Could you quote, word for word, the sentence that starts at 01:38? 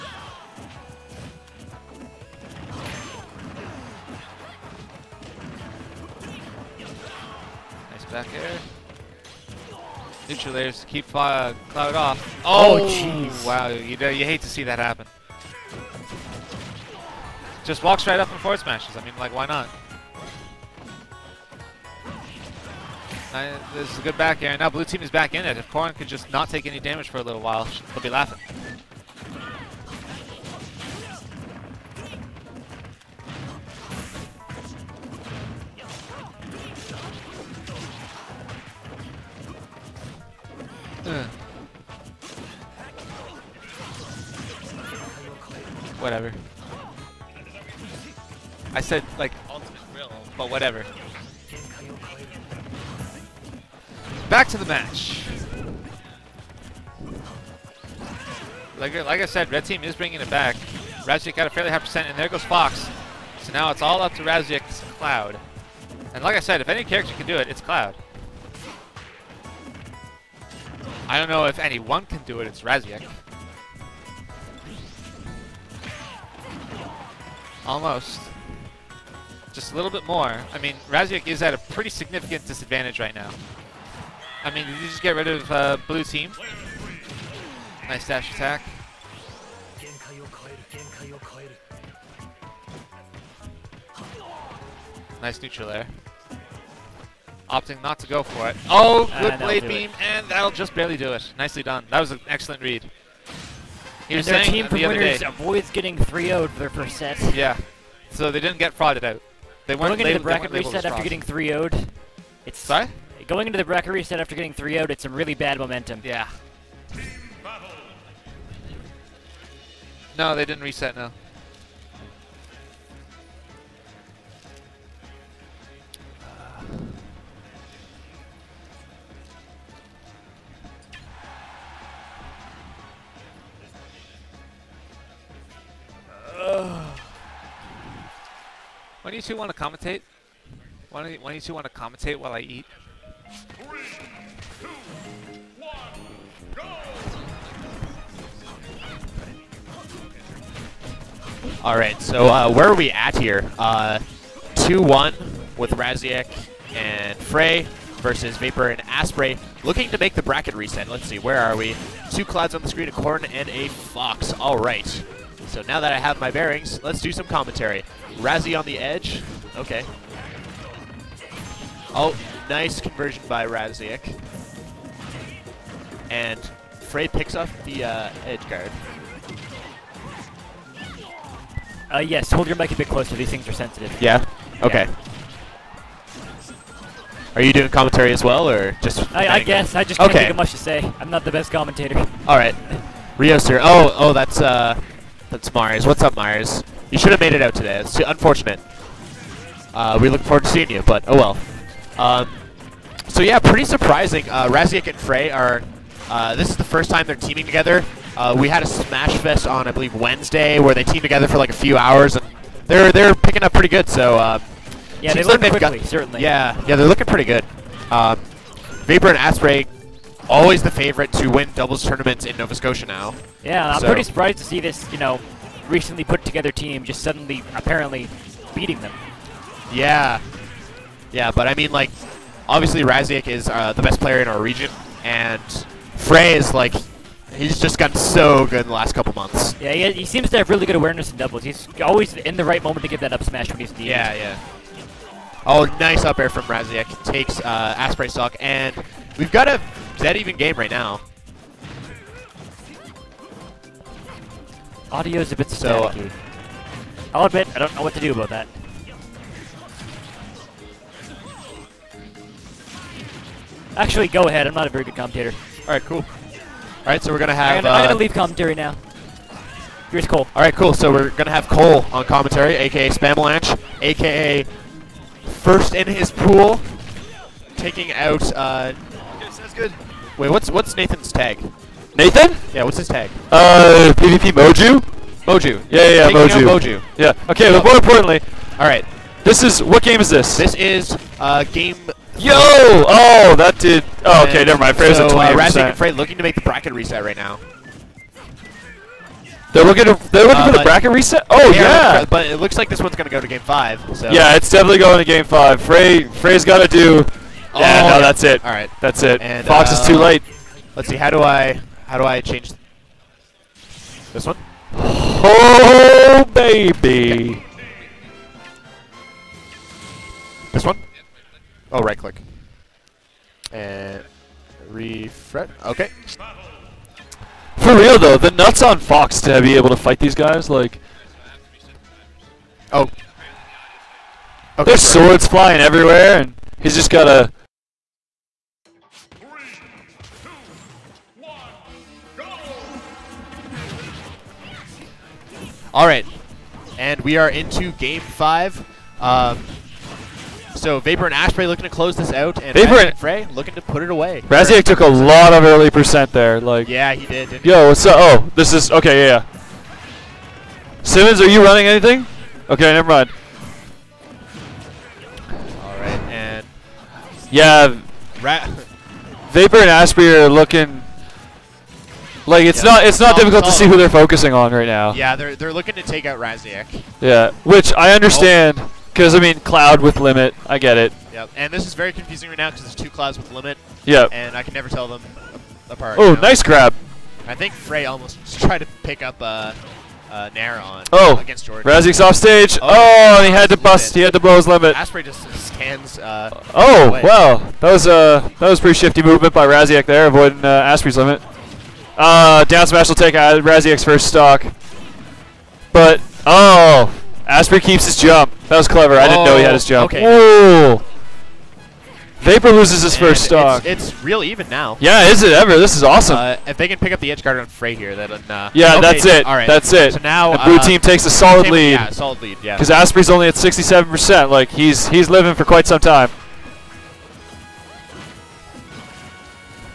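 Oh, good uh, blade beam, it.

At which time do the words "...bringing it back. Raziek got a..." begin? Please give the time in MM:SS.
00:59.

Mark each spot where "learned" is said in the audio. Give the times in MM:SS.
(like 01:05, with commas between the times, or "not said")
03:35.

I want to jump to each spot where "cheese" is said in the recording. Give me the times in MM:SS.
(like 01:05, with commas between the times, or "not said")
not said.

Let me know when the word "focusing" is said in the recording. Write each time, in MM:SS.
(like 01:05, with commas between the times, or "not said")
06:13.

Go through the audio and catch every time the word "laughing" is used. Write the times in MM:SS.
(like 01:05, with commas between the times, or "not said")
00:28.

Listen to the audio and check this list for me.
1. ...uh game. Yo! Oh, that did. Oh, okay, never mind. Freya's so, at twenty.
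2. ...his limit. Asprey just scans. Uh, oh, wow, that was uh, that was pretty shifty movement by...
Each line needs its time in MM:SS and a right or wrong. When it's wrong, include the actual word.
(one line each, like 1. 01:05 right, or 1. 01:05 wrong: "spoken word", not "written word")
1. 04:51 right
2. 06:34 right.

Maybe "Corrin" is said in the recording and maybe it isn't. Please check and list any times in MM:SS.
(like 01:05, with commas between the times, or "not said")
00:25, 02:42.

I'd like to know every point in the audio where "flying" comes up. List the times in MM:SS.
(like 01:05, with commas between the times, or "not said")
05:35.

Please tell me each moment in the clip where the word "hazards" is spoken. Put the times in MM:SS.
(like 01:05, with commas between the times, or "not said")
not said.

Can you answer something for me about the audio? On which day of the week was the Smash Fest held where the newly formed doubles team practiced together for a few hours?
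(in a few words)
Wednesday.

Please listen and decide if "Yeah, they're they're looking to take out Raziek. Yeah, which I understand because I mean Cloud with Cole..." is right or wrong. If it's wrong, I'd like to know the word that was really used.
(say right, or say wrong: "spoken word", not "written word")
wrong: "Limit", not "Cole".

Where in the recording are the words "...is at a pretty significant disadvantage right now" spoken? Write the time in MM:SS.
01:21.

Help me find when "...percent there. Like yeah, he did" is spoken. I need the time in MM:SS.
05:55.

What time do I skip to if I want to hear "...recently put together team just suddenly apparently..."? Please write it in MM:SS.
03:45.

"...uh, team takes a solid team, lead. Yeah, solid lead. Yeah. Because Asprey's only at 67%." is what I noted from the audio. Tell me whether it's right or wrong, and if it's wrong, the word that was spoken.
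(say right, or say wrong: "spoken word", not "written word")
right.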